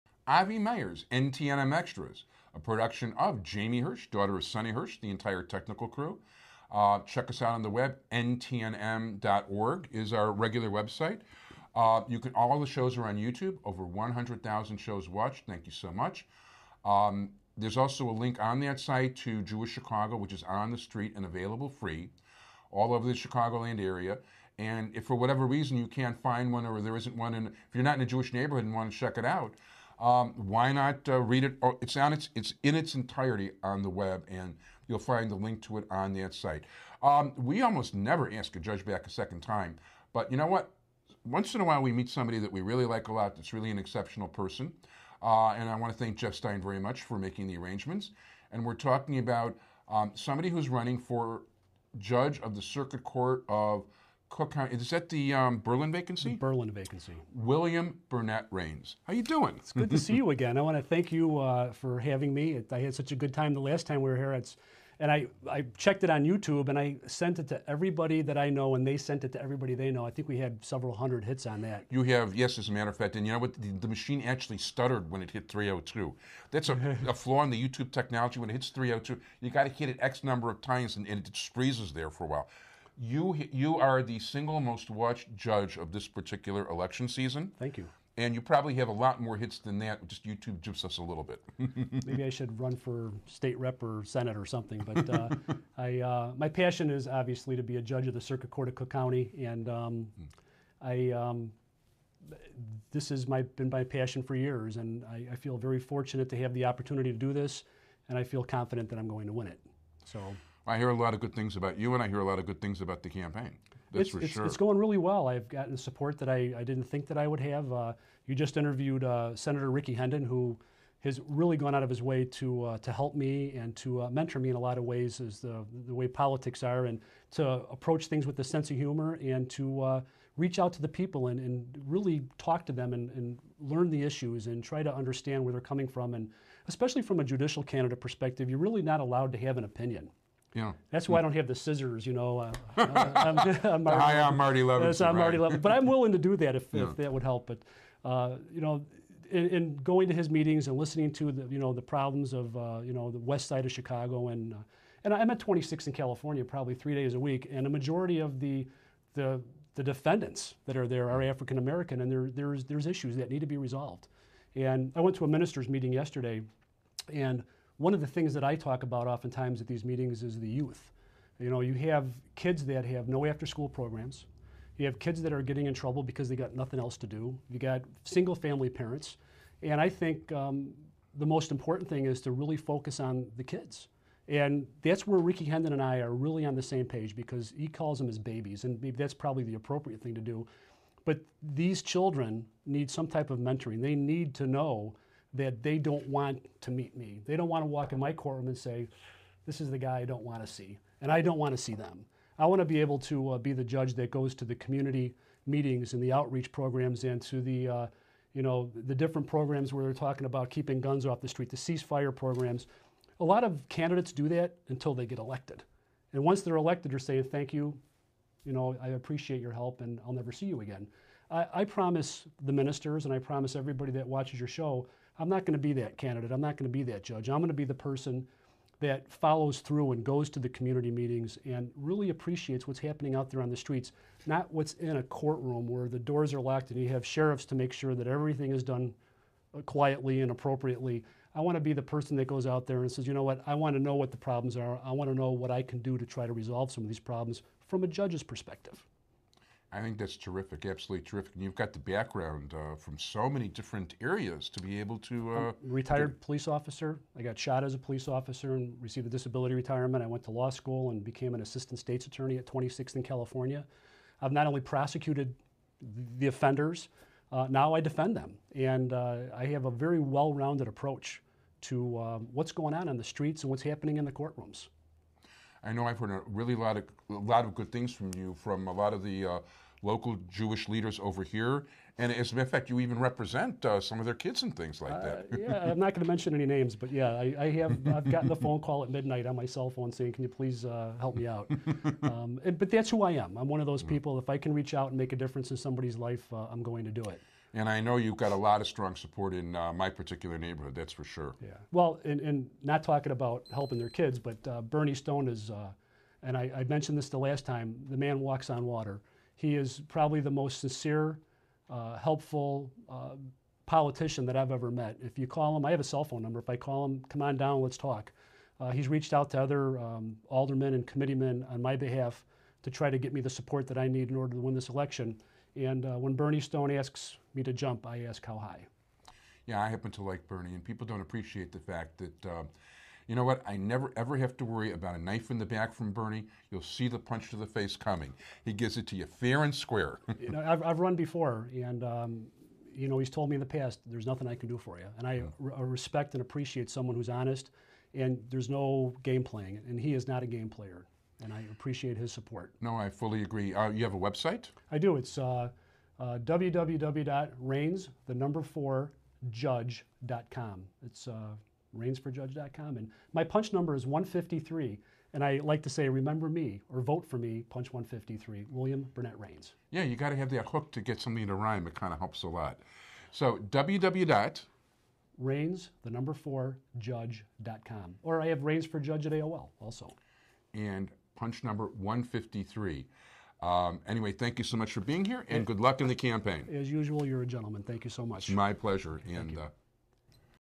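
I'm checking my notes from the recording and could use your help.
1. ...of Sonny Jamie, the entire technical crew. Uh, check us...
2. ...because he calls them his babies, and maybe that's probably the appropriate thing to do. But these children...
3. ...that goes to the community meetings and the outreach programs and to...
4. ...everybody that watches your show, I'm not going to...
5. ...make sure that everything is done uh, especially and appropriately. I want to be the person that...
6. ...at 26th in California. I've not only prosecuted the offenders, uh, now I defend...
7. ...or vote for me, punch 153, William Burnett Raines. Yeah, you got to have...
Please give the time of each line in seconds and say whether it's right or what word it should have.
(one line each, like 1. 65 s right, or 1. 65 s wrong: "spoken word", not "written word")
1. 4 s wrong: "Hirsch", not "Jamie"
2. 187 s right
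3. 203 s right
4. 223 s right
5. 237 s wrong: "quietly", not "especially"
6. 262 s right
7. 366 s right.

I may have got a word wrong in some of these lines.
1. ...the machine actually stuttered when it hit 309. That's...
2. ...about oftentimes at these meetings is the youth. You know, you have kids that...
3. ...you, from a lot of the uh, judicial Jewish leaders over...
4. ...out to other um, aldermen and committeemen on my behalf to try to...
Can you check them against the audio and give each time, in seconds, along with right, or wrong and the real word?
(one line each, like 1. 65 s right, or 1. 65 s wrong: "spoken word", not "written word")
1. 73 s wrong: "302", not "309"
2. 168 s right
3. 278 s wrong: "local", not "judicial"
4. 319 s right.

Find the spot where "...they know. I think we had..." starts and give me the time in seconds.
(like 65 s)
69 s.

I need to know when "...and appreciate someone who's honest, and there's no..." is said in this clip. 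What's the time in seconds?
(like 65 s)
346 s.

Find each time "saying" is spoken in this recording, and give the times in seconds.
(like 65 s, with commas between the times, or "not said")
216 s, 289 s.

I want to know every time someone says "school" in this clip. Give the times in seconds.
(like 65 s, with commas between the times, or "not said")
173 s, 260 s.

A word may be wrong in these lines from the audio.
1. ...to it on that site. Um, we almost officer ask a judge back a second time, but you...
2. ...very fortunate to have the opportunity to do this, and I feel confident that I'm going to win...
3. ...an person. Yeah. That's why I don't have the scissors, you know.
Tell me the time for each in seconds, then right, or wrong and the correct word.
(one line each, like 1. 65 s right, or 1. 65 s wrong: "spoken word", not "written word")
1. 35 s wrong: "never", not "officer"
2. 105 s right
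3. 139 s wrong: "opinion", not "person".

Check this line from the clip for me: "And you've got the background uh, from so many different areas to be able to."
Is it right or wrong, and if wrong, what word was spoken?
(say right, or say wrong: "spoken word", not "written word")
right.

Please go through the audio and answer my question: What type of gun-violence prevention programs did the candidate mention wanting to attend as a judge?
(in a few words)
ceasefire programs.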